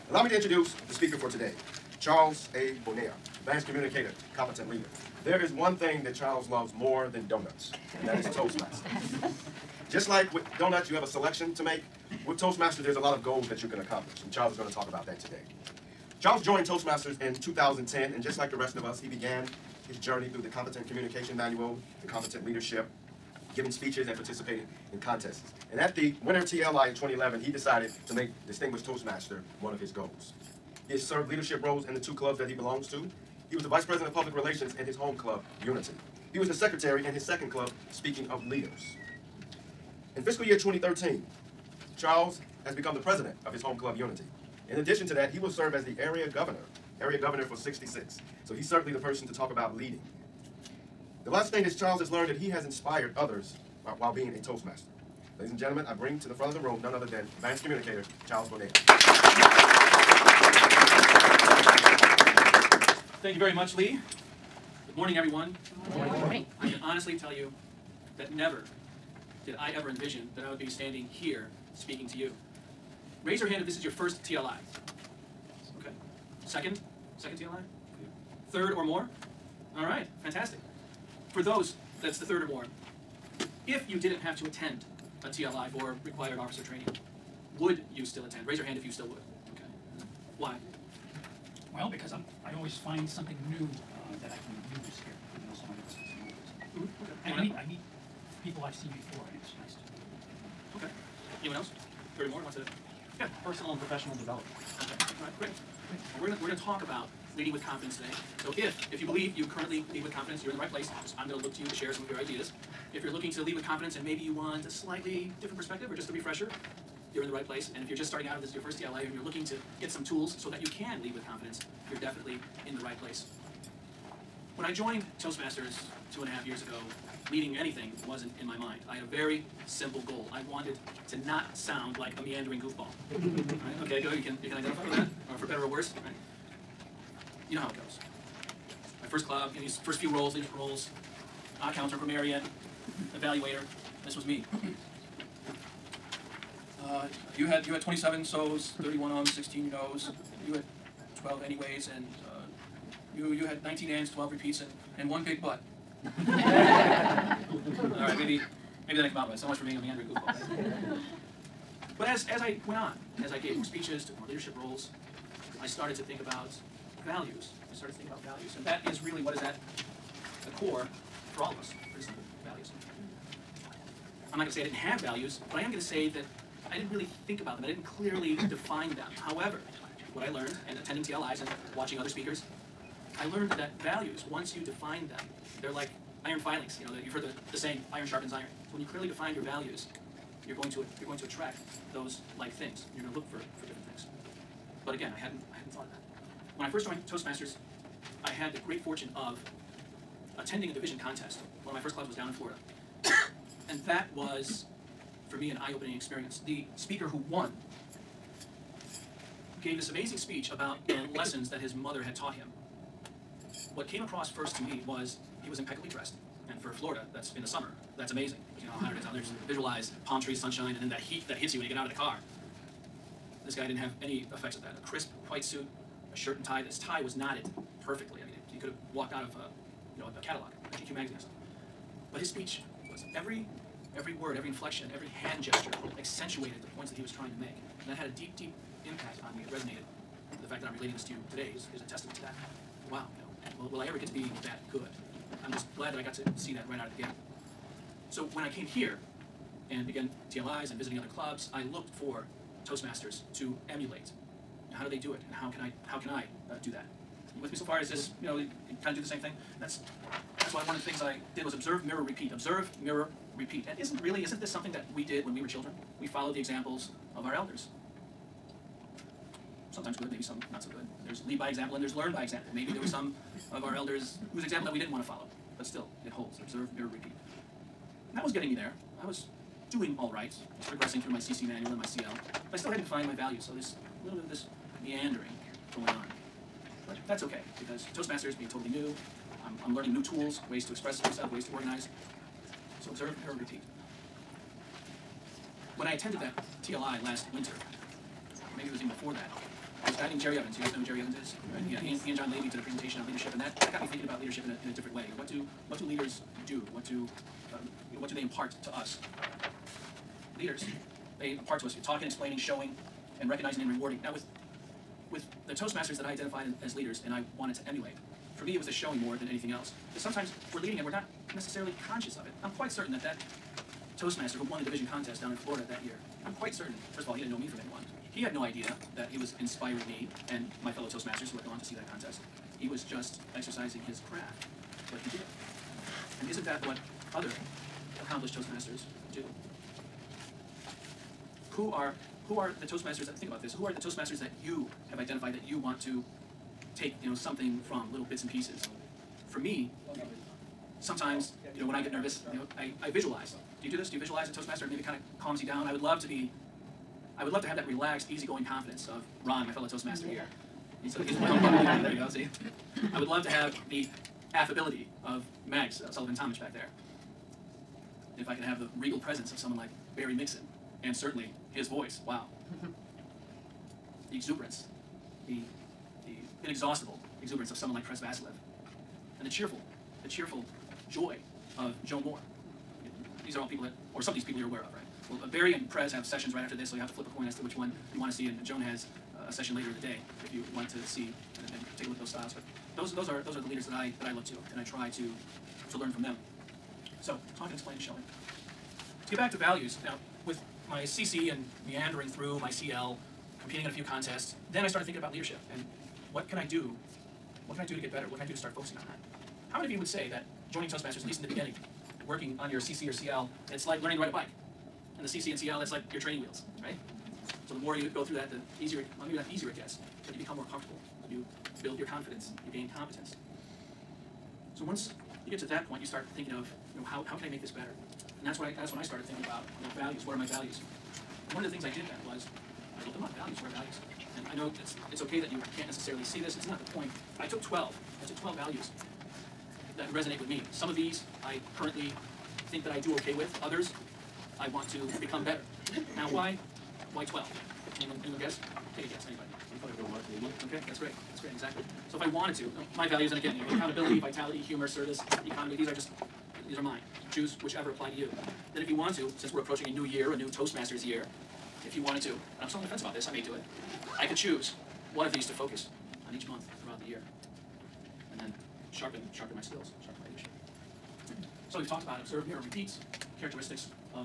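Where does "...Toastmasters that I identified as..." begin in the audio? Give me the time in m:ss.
5:15.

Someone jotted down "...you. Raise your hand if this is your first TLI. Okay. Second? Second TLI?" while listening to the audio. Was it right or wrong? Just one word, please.
right.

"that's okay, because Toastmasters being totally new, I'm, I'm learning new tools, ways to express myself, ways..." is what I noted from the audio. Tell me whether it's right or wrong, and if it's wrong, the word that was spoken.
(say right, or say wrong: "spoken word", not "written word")
right.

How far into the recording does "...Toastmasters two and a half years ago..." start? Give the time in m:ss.
2:05.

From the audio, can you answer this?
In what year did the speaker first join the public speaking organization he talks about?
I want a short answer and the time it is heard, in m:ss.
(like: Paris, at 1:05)
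2010, at 0:17.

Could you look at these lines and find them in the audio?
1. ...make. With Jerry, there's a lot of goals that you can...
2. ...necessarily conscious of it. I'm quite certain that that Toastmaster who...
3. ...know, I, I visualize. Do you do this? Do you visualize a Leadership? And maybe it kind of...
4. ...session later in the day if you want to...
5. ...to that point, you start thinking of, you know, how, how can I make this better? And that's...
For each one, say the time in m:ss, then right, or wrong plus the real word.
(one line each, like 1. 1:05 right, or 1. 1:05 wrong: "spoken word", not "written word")
1. 0:11 wrong: "Toastmasters", not "Jerry"
2. 5:21 right
3. 5:52 wrong: "Toastmaster", not "Leadership"
4. 6:29 right
5. 7:05 right.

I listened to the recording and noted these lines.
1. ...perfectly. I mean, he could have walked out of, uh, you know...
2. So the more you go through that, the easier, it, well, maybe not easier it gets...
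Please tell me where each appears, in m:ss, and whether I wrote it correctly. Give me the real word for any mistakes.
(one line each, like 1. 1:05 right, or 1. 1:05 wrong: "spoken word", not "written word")
1. 3:47 right
2. 6:57 right.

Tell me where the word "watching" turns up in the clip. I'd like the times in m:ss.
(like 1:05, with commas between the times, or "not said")
3:01.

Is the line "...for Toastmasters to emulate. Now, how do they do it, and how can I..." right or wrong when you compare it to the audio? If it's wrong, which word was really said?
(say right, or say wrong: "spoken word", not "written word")
right.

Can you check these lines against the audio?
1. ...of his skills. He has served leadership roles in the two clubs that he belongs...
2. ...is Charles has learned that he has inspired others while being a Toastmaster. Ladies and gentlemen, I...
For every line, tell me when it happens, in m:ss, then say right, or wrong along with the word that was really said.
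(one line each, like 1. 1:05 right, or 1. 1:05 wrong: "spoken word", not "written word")
1. 0:29 wrong: "goals", not "skills"
2. 0:51 right.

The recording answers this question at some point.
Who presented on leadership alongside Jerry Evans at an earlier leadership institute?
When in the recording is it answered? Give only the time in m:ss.
5:02.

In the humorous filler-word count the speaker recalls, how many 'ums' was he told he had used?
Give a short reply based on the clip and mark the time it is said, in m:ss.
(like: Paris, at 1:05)
31, at 2:28.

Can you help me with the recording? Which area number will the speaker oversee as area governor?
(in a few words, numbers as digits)
66.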